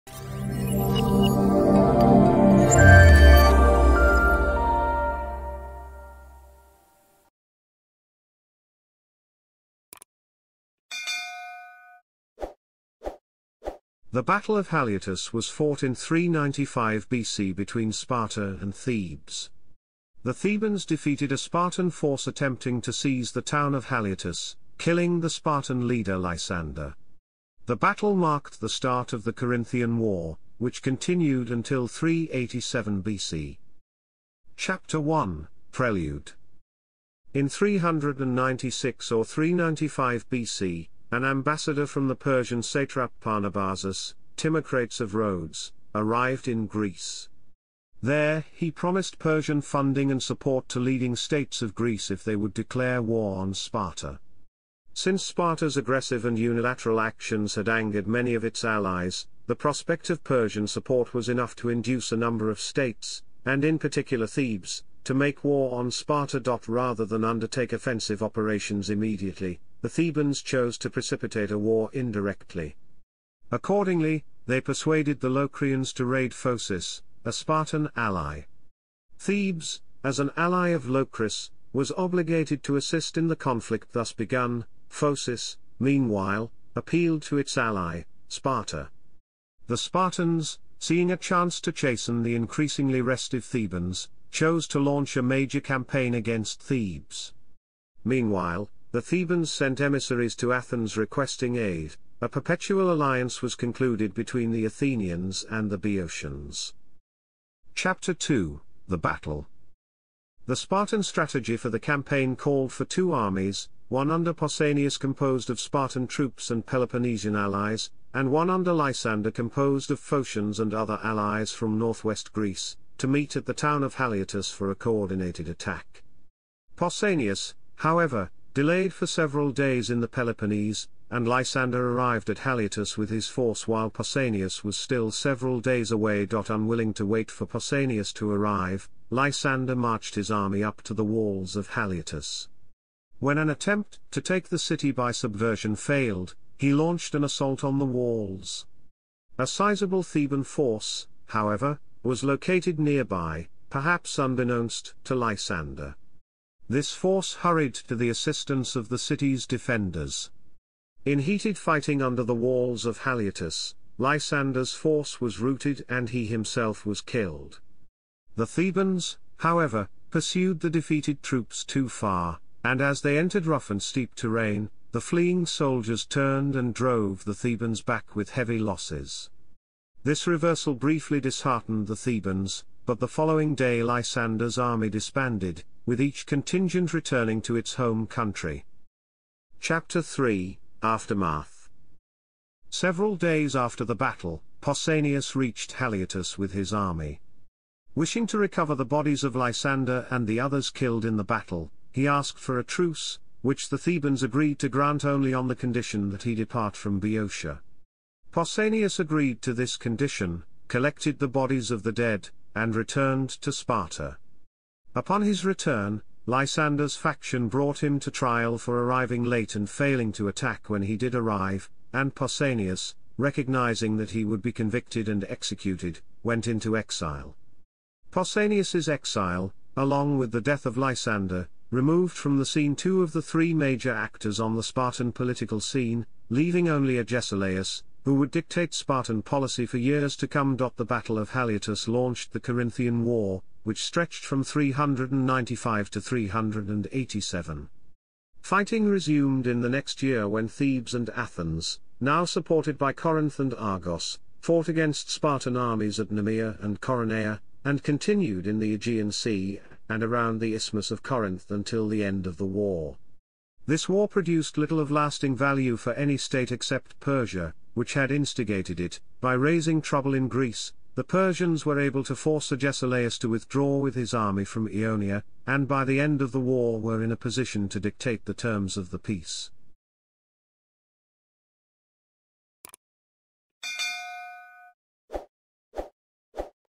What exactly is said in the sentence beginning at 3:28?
Pausanias agreed to this condition, collected the bodies of the dead, and returned to Sparta.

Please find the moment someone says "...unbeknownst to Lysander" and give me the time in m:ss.
2:34.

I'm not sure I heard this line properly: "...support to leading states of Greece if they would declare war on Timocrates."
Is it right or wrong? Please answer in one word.
wrong.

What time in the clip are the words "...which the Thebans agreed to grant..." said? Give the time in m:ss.
3:23.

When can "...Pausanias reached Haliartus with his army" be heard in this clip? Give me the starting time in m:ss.
3:14.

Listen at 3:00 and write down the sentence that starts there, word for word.
This reversal briefly disheartened the Thebans, but the following day Lysander's army disbanded, with each contingent returning to its home country.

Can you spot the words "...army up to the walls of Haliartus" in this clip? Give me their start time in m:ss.
2:20.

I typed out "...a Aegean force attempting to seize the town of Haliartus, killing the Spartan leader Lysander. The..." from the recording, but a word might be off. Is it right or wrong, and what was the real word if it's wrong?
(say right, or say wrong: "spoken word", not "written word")
wrong: "Spartan", not "Aegean".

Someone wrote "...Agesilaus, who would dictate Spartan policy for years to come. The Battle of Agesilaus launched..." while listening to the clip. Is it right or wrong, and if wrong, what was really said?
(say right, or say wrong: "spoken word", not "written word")
wrong: "Haliartus", not "Agesilaus".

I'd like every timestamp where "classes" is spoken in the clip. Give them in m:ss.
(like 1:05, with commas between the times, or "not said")
not said.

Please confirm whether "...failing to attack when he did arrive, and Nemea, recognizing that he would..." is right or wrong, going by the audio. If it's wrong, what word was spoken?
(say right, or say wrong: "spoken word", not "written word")
wrong: "Pausanias", not "Nemea".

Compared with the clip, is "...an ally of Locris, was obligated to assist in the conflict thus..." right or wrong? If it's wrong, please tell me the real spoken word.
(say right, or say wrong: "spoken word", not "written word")
right.